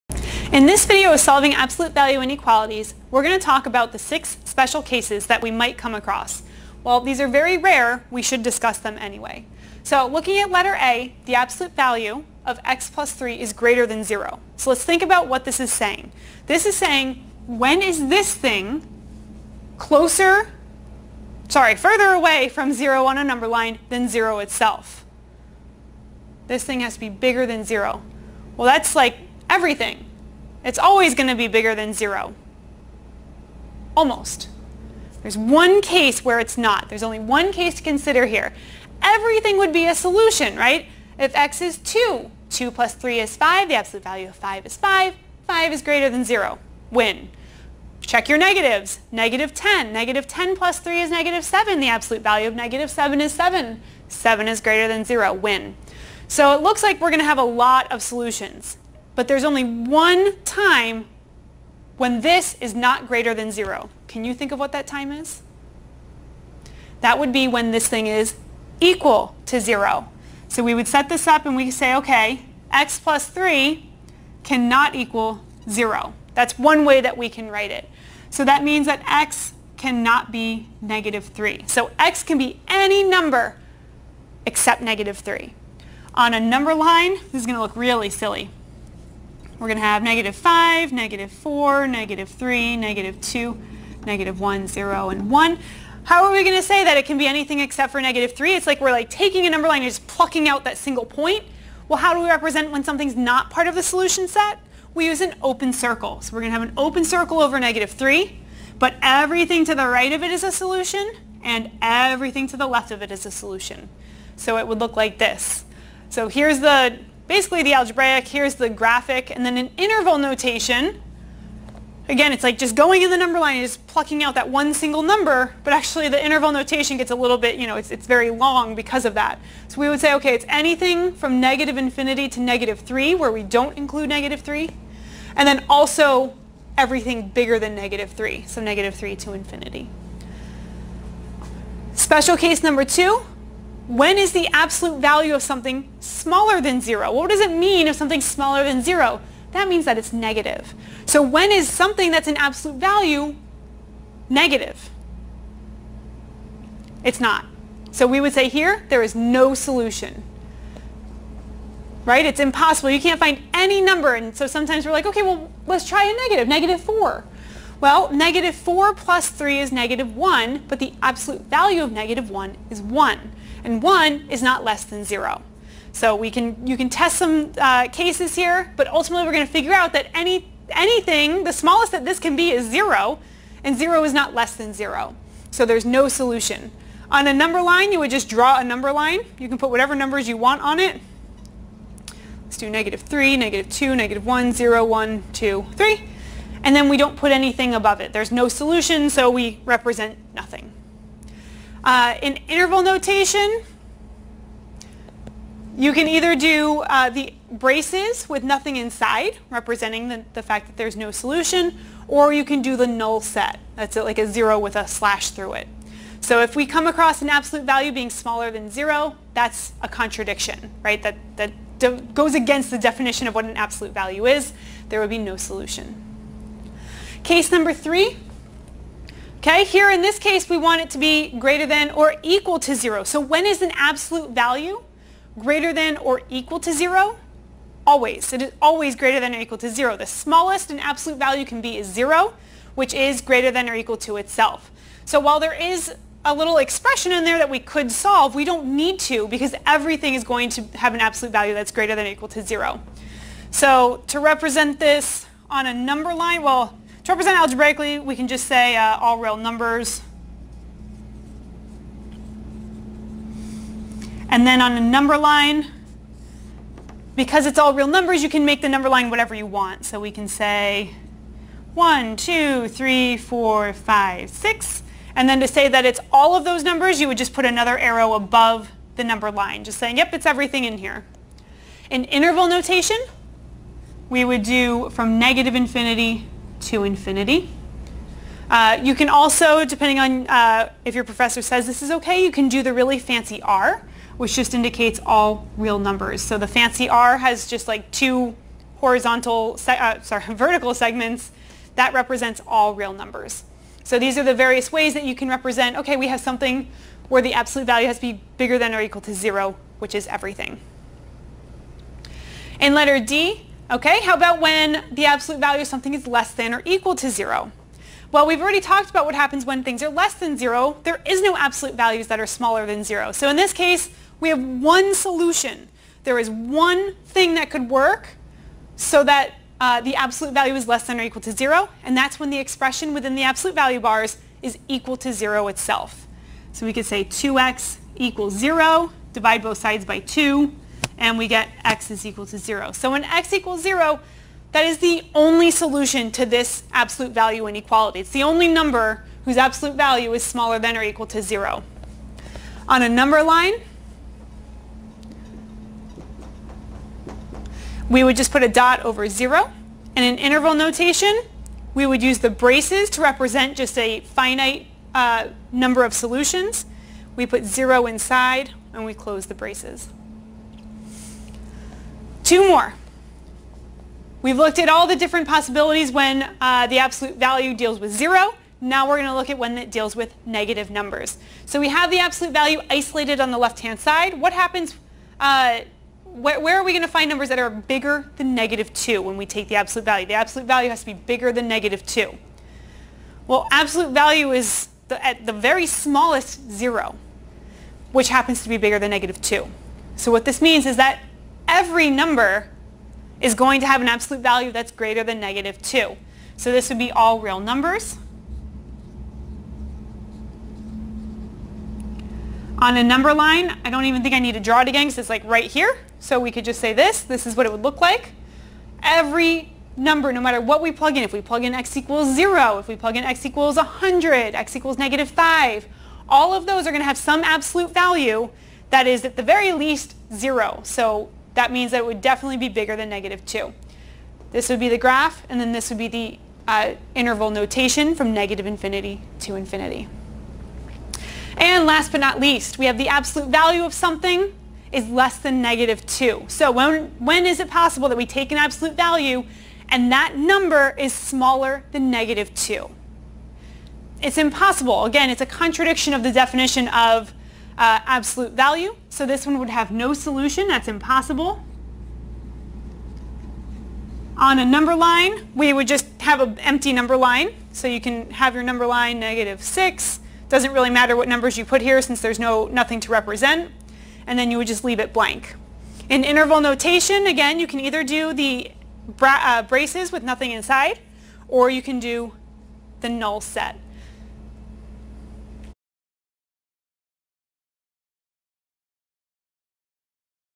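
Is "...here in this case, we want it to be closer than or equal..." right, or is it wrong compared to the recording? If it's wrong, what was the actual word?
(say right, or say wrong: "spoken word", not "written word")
wrong: "greater", not "closer".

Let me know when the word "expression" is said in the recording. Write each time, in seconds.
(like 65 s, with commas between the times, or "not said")
246 s, 332 s.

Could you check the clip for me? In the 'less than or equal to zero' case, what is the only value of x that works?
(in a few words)
0.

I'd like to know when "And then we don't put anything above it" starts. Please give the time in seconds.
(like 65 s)
196 s.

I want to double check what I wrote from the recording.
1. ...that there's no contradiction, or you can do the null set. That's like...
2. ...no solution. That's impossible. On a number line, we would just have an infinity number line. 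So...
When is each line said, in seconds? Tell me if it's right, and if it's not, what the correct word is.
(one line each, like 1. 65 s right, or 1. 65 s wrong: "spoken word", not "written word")
1. 210 s wrong: "solution", not "contradiction"
2. 459 s wrong: "empty", not "infinity".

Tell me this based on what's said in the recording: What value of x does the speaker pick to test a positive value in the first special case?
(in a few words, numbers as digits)
2.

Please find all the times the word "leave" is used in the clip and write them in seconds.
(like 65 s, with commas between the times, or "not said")
474 s.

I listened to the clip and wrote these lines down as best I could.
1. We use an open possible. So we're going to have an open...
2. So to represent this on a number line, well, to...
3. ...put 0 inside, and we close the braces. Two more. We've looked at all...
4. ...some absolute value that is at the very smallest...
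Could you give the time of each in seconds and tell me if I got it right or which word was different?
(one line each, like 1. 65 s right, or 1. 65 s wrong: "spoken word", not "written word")
1. 104 s wrong: "circle", not "possible"
2. 253 s right
3. 367 s right
4. 426 s wrong: "least", not "smallest".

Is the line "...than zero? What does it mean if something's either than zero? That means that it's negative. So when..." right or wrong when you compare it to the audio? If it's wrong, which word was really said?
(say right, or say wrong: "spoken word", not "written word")
wrong: "smaller", not "either".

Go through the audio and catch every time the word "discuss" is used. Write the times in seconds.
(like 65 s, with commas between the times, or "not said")
8 s.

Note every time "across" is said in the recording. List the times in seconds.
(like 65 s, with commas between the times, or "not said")
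5 s, 216 s.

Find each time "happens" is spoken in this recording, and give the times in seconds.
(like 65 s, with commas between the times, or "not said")
319 s, 384 s, 398 s.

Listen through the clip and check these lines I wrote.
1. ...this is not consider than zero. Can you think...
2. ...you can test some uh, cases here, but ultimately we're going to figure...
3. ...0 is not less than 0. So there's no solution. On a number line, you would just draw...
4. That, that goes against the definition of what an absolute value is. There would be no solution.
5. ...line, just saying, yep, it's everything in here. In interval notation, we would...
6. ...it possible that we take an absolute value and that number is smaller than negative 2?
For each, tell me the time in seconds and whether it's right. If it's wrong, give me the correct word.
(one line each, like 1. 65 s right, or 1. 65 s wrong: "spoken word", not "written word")
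1. 62 s wrong: "greater", not "consider"
2. 176 s right
3. 183 s right
4. 221 s right
5. 279 s right
6. 447 s right.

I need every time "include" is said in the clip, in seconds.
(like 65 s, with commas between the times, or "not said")
133 s.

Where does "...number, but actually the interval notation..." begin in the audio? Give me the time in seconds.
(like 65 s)
125 s.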